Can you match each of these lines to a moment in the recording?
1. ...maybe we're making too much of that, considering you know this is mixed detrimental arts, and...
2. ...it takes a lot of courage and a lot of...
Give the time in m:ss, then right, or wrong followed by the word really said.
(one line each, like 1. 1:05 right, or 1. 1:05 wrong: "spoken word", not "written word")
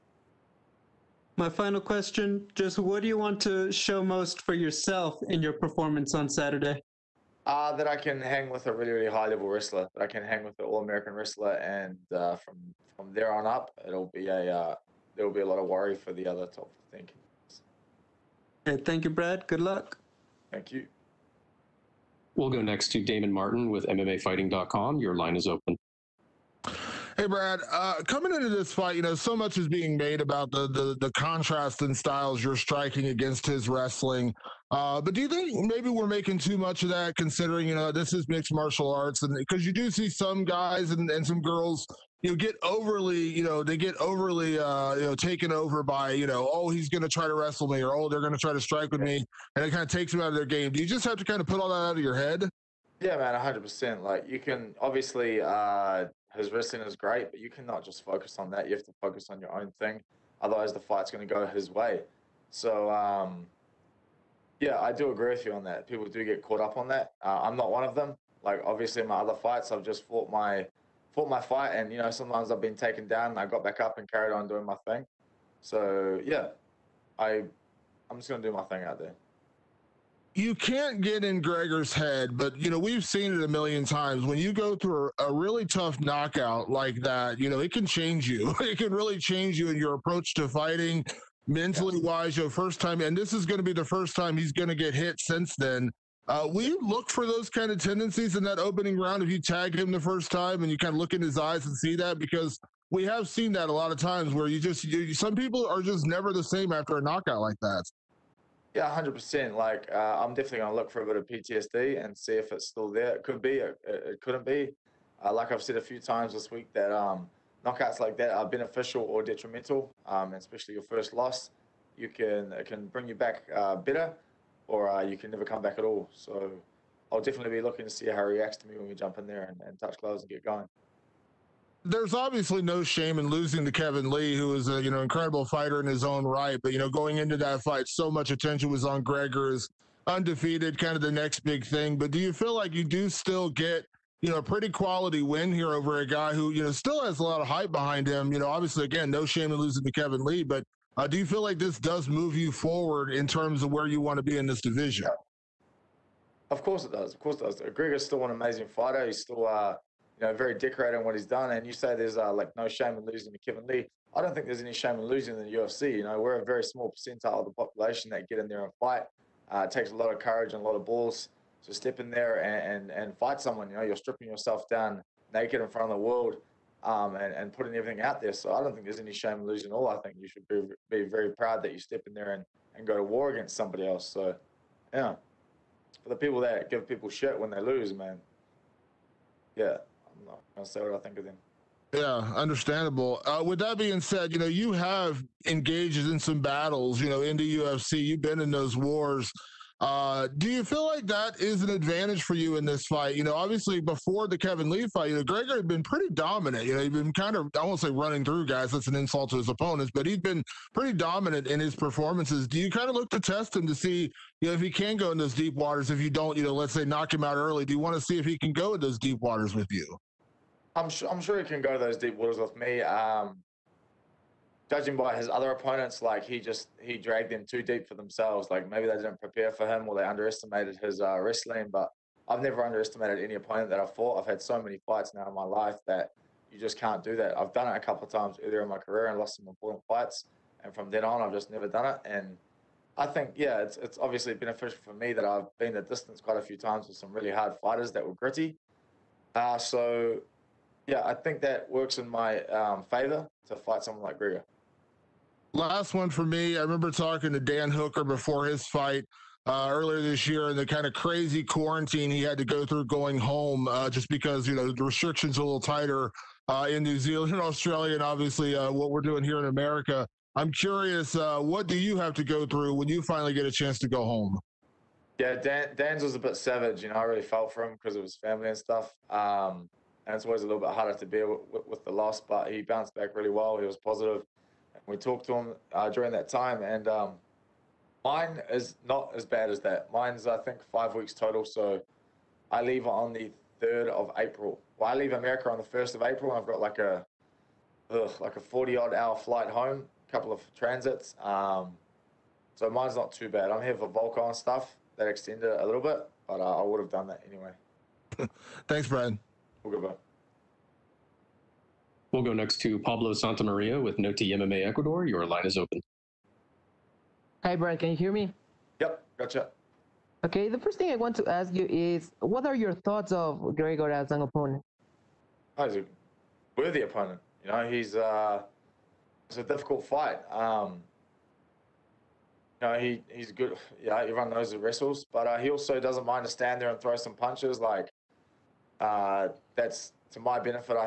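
1. 0:35 wrong: "martial", not "detrimental"
2. 2:49 right.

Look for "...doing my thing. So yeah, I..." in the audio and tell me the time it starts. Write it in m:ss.
1:14.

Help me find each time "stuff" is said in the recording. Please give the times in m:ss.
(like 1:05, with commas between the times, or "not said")
4:38, 5:04.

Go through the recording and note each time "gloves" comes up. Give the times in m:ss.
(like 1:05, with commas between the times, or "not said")
2:09.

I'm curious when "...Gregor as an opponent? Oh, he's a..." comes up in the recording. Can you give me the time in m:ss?
5:23.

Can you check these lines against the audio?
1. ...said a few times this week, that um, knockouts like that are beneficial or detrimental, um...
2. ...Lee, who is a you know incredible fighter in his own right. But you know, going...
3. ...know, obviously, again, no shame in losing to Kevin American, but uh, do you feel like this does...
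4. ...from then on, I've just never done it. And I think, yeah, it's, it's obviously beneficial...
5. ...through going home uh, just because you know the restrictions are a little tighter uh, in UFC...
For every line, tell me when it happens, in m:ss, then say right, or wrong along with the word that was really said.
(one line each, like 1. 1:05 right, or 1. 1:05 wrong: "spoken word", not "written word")
1. 1:55 right
2. 2:14 right
3. 2:28 wrong: "Lee", not "American"
4. 4:00 right
5. 4:22 wrong: "New", not "UFC".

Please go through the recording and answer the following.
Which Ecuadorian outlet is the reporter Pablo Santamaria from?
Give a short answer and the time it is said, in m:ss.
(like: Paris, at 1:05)
Noti MMA Ecuador, at 5:13.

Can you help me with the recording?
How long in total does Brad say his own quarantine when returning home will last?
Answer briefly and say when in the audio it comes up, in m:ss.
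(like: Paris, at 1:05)
5 weeks, at 4:50.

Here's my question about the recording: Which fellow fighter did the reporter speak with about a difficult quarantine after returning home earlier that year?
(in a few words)
Dan Hooker.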